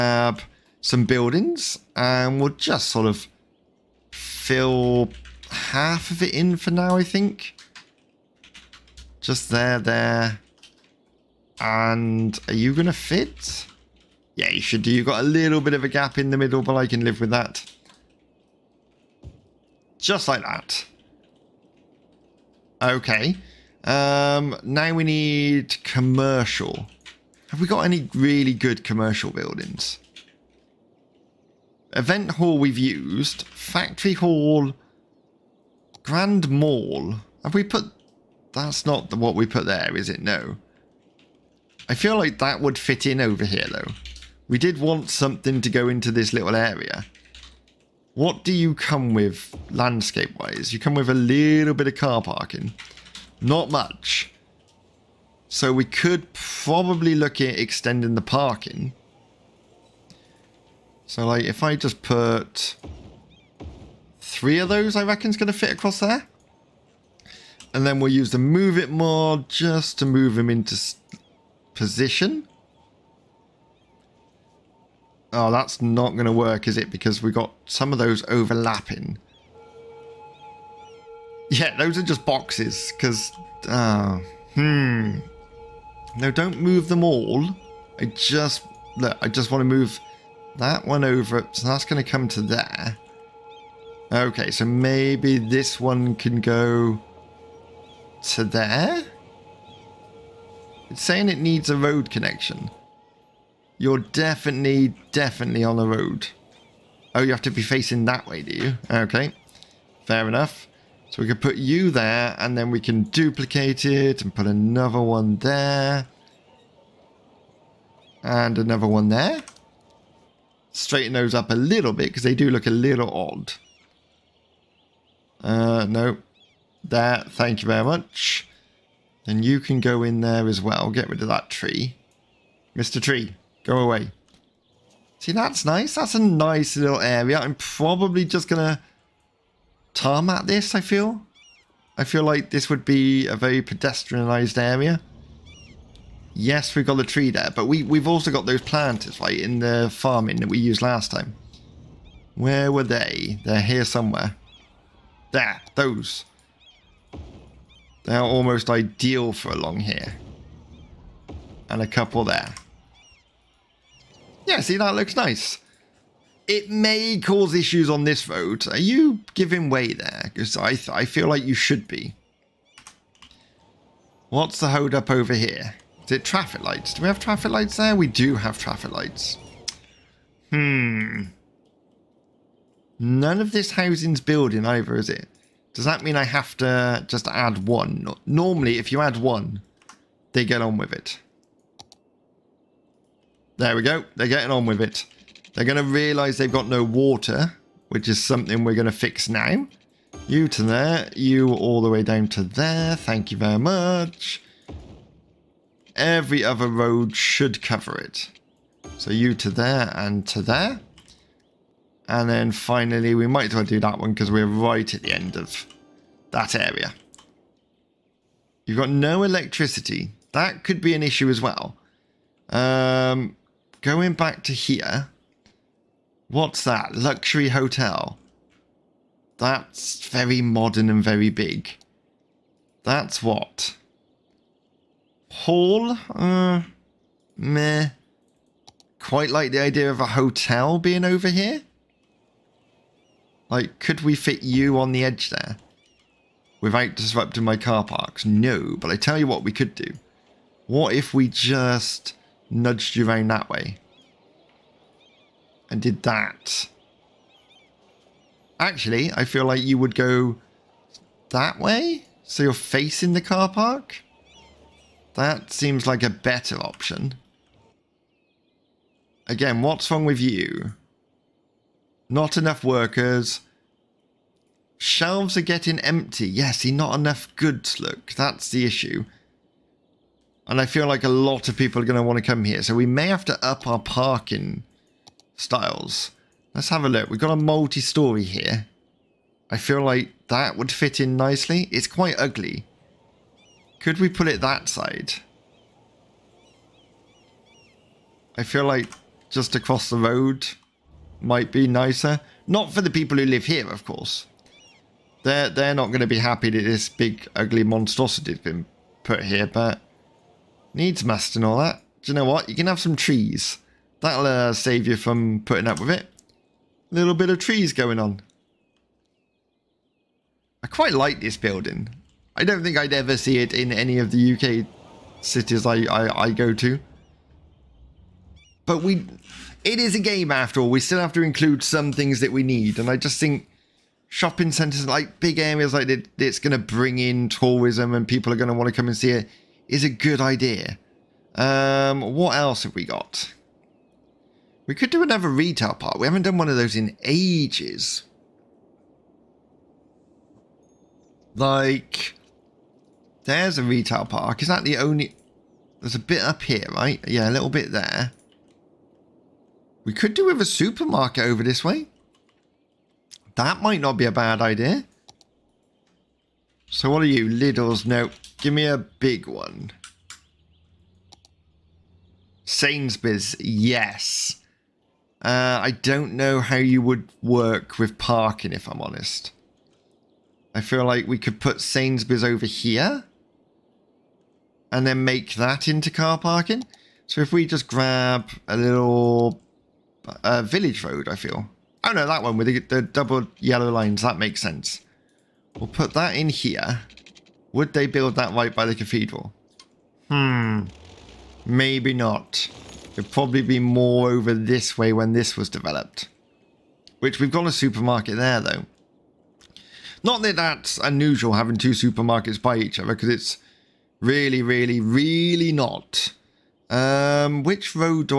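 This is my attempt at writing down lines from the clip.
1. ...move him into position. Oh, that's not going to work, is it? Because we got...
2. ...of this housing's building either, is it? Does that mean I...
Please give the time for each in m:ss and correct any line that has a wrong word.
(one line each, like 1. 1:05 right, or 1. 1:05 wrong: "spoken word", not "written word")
1. 1:10 right
2. 3:03 right.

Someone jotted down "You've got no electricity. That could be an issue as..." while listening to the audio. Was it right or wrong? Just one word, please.
right.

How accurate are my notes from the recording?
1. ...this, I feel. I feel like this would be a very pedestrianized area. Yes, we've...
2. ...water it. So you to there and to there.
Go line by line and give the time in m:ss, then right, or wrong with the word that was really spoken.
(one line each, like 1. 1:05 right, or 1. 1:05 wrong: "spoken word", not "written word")
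1. 2:20 right
2. 3:27 wrong: "cover", not "water".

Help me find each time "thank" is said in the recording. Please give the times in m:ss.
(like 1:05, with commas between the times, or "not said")
2:07, 3:22.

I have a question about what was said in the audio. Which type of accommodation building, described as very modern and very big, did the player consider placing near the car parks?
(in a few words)
Luxury hotel.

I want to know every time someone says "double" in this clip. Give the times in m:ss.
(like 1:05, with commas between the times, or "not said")
6:32.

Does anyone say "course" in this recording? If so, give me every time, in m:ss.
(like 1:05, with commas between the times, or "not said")
5:03.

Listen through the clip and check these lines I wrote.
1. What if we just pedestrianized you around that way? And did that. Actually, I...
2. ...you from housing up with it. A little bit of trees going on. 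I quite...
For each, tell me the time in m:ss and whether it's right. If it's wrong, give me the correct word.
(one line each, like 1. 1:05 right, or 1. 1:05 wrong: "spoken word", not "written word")
1. 4:10 wrong: "nudged", not "pedestrianized"
2. 5:14 wrong: "putting", not "housing".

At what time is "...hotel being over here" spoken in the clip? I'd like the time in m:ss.
4:00.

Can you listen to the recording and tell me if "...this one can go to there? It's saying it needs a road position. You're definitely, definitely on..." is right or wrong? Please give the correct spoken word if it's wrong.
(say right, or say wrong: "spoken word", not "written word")
wrong: "connection", not "position".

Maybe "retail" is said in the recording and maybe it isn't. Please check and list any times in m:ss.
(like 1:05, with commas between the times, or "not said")
5:45, 5:53.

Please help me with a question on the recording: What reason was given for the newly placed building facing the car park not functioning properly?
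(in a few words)
Not enough workers.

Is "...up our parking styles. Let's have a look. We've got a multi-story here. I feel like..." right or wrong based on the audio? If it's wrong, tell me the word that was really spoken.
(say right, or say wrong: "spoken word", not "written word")
right.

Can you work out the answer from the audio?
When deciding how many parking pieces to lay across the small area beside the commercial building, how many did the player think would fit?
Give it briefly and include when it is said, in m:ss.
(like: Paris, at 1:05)
3, at 1:04.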